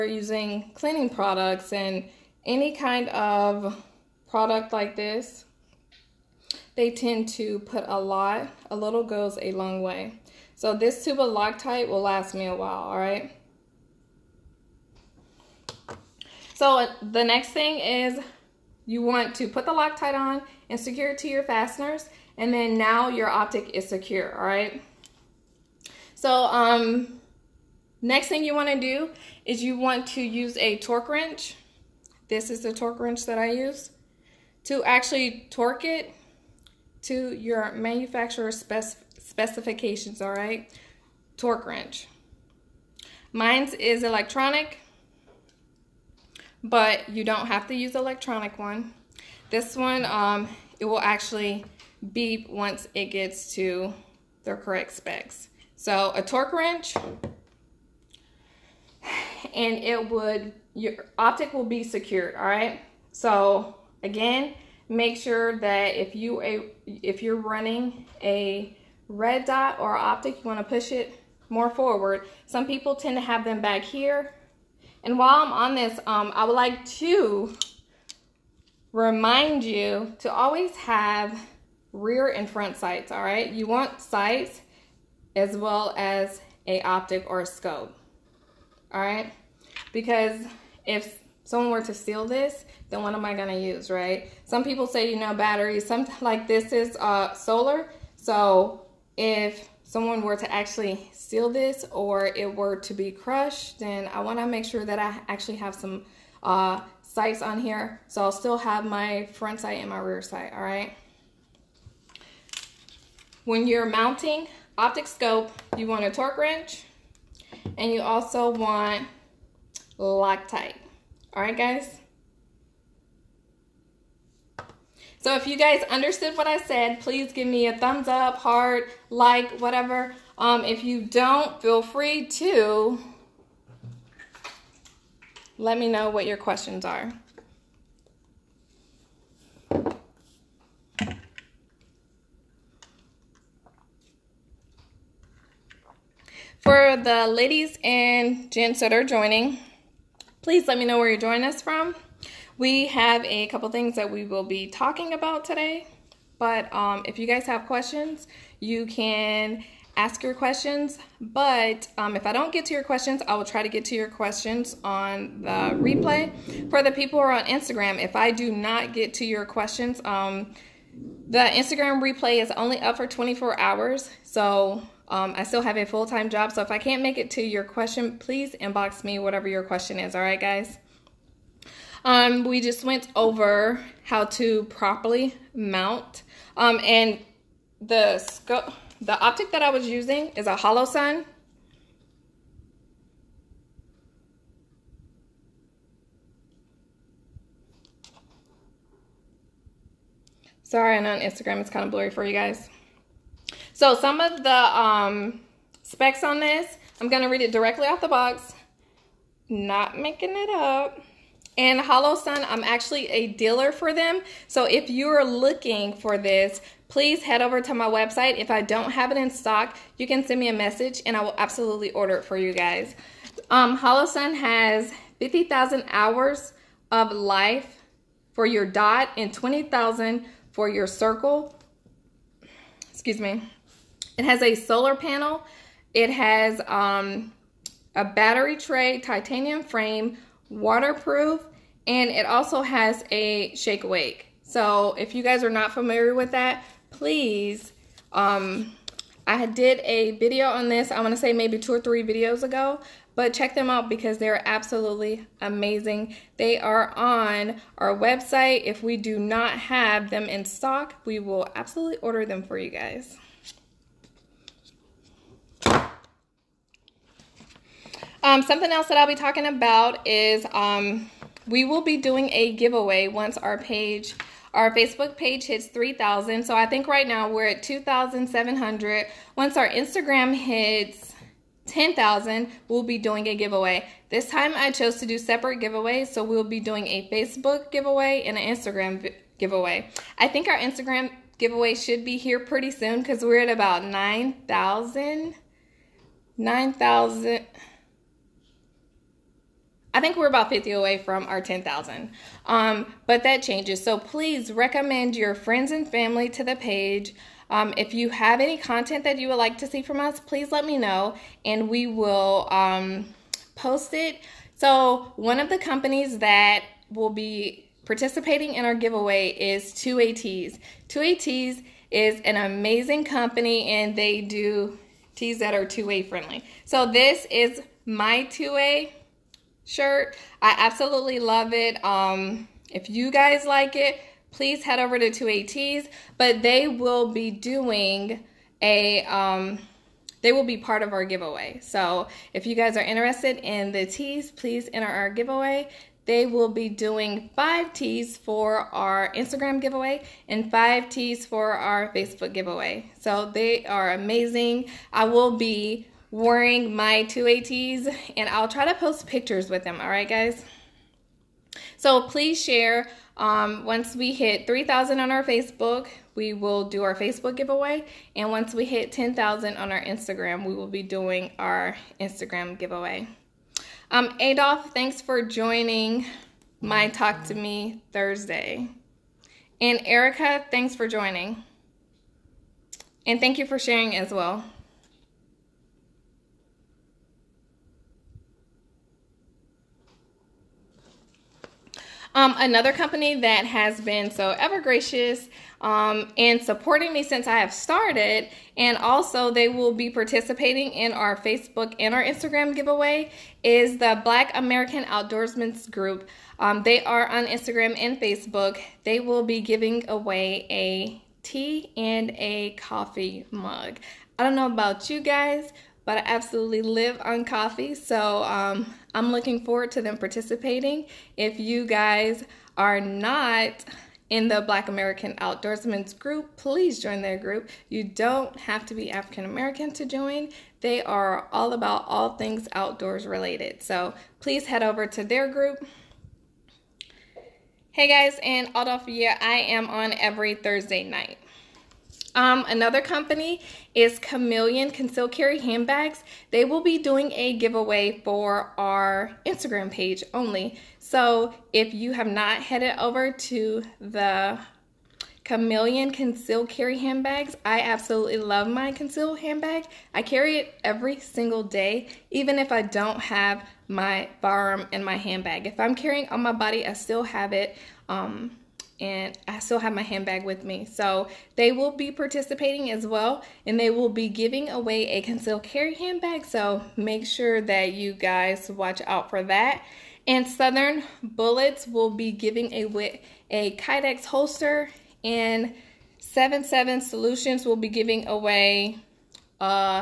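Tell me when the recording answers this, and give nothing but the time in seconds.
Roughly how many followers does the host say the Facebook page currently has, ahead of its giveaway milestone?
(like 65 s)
277 s.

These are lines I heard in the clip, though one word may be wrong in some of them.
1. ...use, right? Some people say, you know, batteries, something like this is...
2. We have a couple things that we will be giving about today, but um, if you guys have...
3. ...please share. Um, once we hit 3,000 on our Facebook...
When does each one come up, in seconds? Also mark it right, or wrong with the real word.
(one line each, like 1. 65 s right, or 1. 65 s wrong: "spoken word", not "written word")
1. 93 s right
2. 152 s wrong: "talking", not "giving"
3. 362 s right.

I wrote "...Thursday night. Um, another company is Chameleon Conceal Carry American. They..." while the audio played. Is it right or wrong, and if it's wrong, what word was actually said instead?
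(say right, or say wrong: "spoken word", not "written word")
wrong: "Handbags", not "American".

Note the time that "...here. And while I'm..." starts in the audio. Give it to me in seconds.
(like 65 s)
73 s.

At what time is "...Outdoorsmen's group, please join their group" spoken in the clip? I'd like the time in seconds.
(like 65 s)
425 s.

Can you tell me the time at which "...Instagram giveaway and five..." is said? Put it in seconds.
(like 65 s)
349 s.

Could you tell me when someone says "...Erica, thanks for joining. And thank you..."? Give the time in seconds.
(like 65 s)
379 s.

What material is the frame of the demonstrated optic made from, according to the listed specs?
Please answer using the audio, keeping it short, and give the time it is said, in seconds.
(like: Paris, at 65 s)
titanium, at 238 s.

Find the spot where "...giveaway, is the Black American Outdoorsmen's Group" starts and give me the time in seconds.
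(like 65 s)
402 s.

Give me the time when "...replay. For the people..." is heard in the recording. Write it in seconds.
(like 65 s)
165 s.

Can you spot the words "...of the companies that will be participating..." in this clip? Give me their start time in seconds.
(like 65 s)
315 s.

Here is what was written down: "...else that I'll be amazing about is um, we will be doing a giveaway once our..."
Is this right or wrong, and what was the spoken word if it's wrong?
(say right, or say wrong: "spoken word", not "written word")
wrong: "talking", not "amazing".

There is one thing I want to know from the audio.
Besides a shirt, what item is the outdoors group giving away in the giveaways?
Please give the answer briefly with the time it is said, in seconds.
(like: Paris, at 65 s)
coffee mug, at 412 s.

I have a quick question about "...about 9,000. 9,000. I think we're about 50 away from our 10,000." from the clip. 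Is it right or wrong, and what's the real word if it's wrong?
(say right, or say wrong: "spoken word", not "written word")
right.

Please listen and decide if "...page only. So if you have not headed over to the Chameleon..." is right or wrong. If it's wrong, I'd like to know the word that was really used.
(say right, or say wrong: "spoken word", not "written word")
right.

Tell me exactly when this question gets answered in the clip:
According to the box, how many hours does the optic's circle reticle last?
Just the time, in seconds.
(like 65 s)
229 s.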